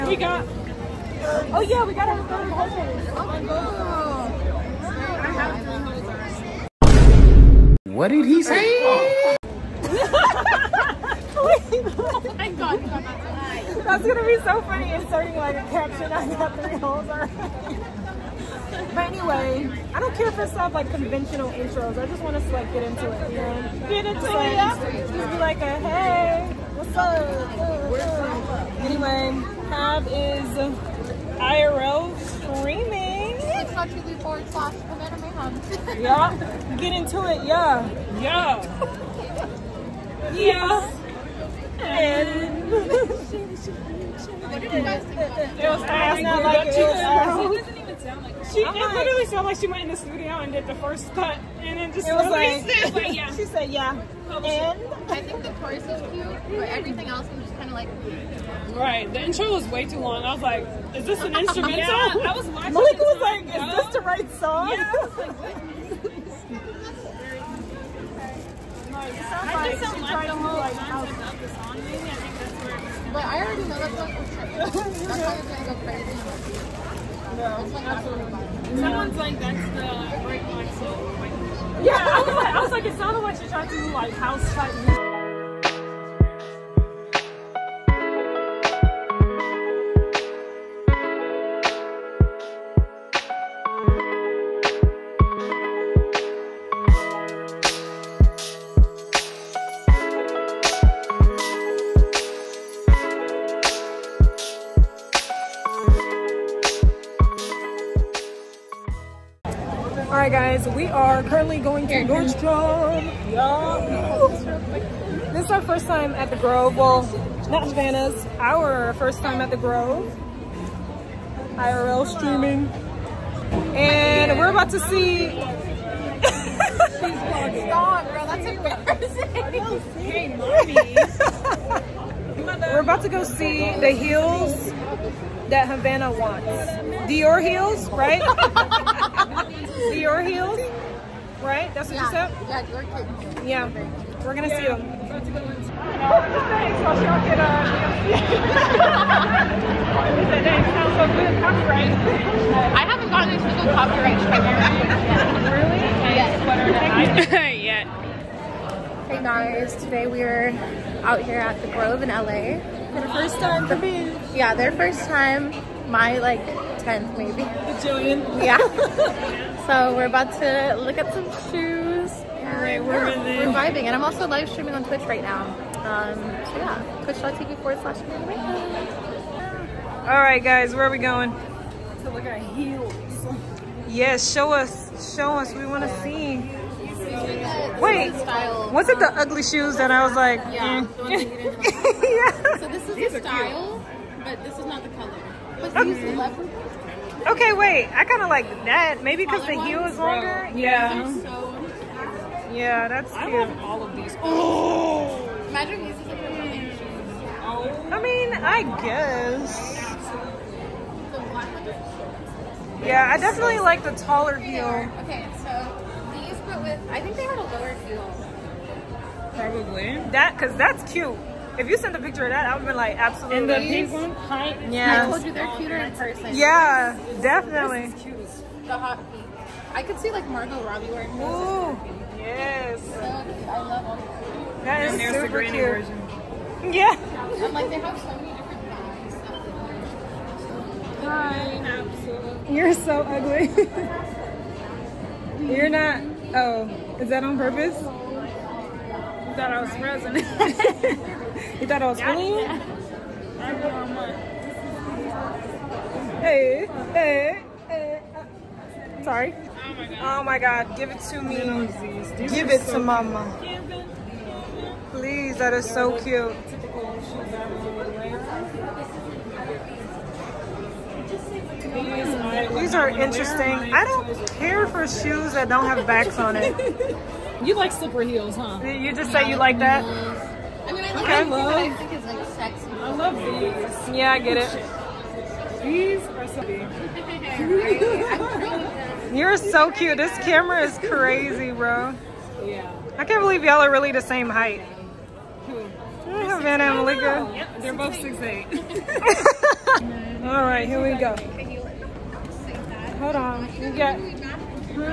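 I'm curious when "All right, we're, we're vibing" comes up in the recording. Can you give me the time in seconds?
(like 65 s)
172 s.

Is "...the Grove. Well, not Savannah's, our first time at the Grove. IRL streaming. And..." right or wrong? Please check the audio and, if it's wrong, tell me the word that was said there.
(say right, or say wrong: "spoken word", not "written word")
right.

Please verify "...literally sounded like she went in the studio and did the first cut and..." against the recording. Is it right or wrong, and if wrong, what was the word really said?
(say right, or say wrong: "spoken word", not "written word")
right.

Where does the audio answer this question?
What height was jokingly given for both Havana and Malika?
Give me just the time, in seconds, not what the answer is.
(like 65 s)
297 s.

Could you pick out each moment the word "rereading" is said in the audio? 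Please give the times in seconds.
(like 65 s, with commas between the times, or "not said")
not said.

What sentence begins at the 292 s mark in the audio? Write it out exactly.
I can't believe y'all are really the same height.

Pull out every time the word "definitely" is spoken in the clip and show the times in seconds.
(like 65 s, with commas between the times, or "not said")
213 s, 227 s.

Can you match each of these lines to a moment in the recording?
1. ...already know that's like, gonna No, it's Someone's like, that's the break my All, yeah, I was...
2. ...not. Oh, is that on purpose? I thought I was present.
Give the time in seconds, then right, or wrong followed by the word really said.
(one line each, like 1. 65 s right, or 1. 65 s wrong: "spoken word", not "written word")
1. 73 s wrong: "Like", not "All"
2. 245 s right.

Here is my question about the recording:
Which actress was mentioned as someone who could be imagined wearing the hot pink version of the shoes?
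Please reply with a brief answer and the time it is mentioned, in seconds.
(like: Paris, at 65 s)
Margot Robbie, at 230 s.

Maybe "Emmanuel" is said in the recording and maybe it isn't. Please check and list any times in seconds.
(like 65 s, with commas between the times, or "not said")
not said.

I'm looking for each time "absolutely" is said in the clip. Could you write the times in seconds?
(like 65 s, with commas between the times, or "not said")
222 s, 241 s.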